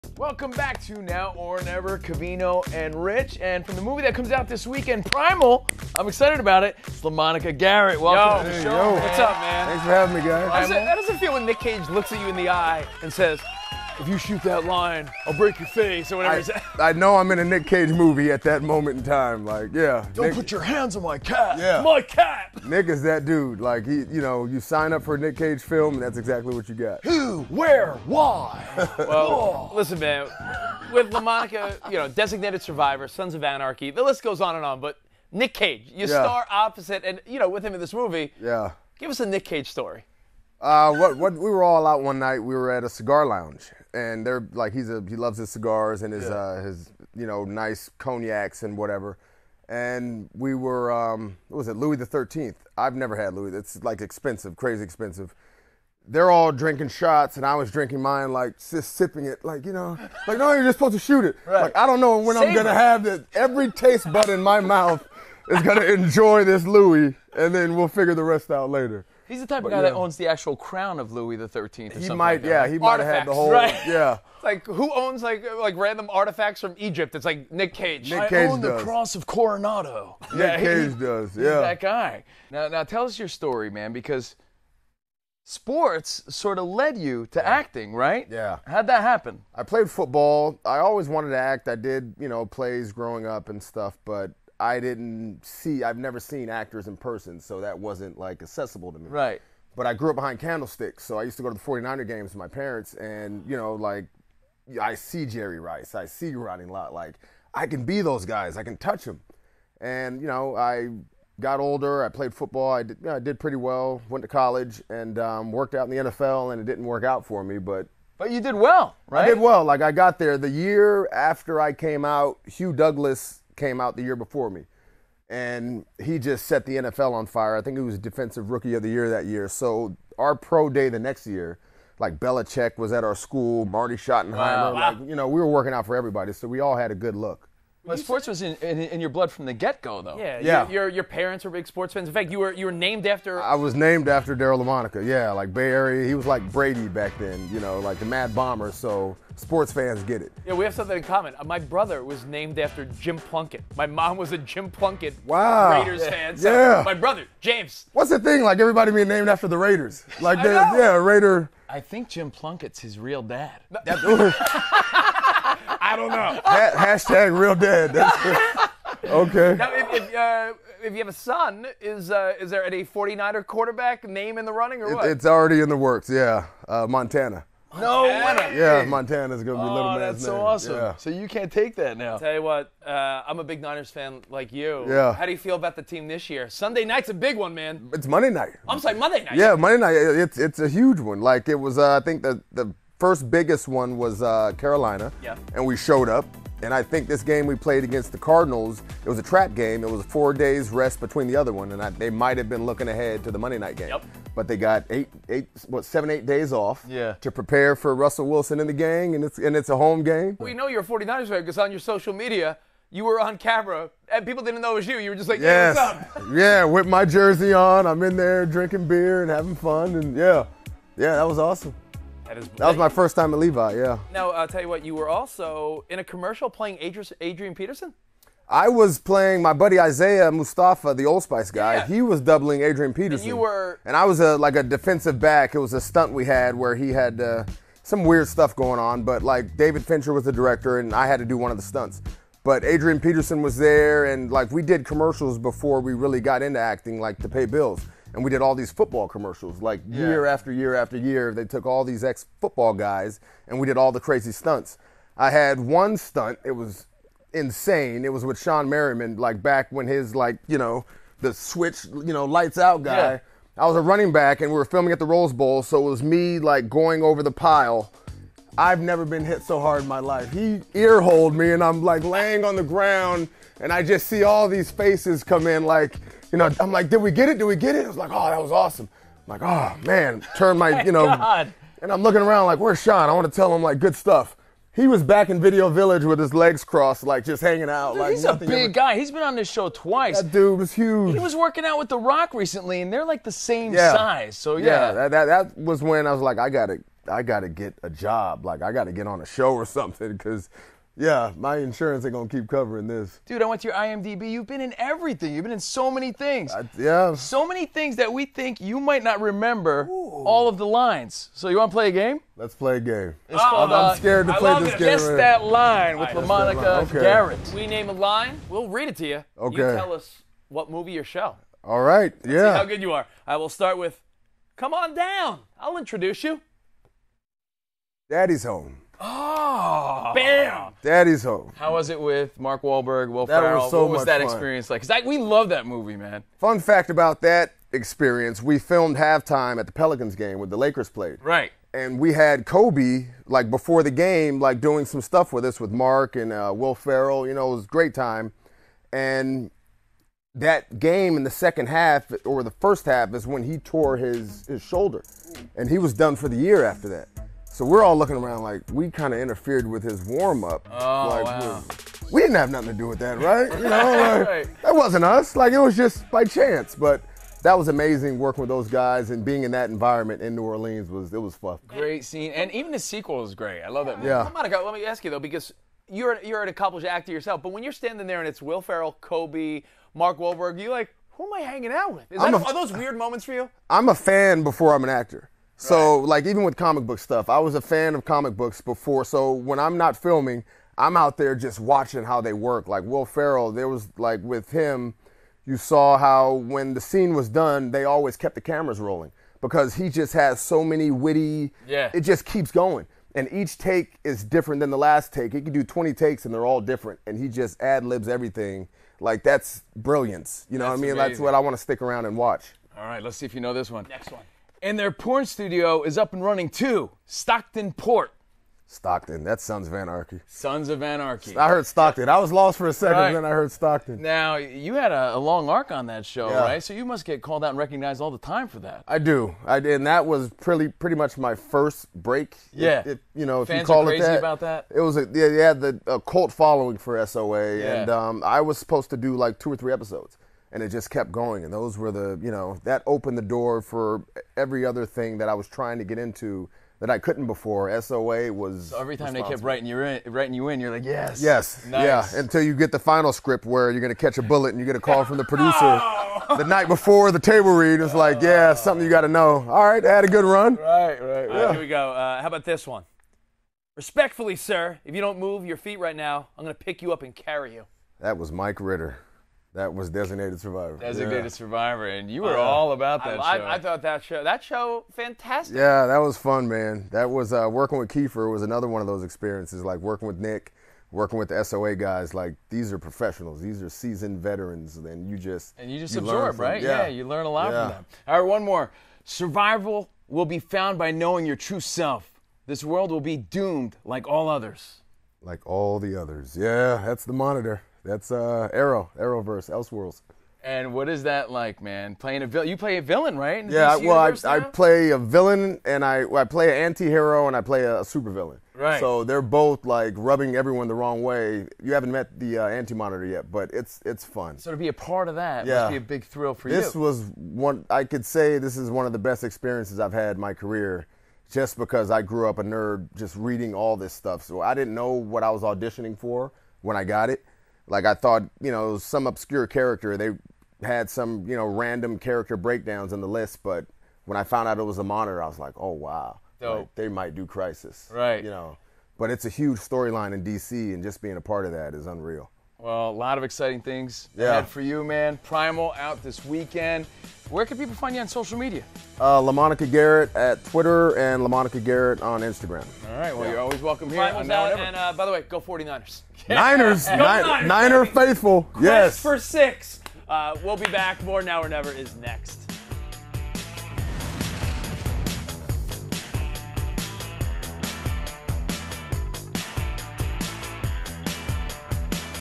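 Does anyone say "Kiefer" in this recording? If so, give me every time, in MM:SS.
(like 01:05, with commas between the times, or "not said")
07:57.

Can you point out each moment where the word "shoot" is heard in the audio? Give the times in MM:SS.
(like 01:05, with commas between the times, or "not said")
00:14, 01:00.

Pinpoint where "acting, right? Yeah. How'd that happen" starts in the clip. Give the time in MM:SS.
01:27.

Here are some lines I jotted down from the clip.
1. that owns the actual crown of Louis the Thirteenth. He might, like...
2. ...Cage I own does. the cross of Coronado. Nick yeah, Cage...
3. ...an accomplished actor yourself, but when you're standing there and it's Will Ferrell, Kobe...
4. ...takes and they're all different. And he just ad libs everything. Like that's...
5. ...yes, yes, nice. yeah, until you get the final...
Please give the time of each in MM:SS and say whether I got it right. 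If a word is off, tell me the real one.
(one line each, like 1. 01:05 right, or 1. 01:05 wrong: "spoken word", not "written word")
1. 01:09 right
2. 01:18 right
3. 06:16 right
4. 06:45 right
5. 07:30 right.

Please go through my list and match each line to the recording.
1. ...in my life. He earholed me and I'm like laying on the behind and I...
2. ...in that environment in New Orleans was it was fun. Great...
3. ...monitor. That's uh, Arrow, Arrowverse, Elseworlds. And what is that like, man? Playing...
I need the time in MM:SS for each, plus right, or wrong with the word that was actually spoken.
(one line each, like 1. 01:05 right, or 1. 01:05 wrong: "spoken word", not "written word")
1. 04:29 wrong: "ground", not "behind"
2. 06:09 right
3. 08:17 right.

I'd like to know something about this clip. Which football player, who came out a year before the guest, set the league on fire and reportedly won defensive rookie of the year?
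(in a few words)
Hugh Douglas.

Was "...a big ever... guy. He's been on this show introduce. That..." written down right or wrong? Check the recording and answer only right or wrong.
wrong.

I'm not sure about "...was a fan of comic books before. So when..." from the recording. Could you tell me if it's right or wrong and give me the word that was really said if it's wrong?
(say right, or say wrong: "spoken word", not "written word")
right.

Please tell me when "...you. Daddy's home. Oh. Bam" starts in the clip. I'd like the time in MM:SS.
05:26.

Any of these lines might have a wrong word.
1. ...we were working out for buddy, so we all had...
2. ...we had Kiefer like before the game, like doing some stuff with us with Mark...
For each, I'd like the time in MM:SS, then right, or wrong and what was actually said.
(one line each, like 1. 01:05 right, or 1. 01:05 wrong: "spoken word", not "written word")
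1. 02:15 wrong: "everybody", not "buddy"
2. 05:41 wrong: "Kobe", not "Kiefer".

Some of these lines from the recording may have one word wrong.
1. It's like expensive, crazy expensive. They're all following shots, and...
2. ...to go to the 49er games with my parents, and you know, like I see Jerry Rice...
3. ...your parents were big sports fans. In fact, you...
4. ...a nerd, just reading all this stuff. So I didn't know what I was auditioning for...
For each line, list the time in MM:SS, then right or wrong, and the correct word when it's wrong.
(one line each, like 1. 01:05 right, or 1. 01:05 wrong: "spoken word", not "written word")
1. 00:53 wrong: "drinking", not "following"
2. 01:41 right
3. 02:20 right
4. 08:42 right.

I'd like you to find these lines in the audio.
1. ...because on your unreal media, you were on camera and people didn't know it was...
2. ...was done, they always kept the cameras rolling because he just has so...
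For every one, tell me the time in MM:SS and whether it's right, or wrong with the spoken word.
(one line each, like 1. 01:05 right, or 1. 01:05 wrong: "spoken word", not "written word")
1. 03:31 wrong: "social", not "unreal"
2. 06:37 right.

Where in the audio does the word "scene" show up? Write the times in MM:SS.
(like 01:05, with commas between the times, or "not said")
06:12, 06:36.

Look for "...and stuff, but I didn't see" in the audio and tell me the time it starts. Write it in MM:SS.
01:33.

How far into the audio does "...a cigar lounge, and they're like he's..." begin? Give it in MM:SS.
00:42.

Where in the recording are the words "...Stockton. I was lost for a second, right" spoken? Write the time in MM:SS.
07:01.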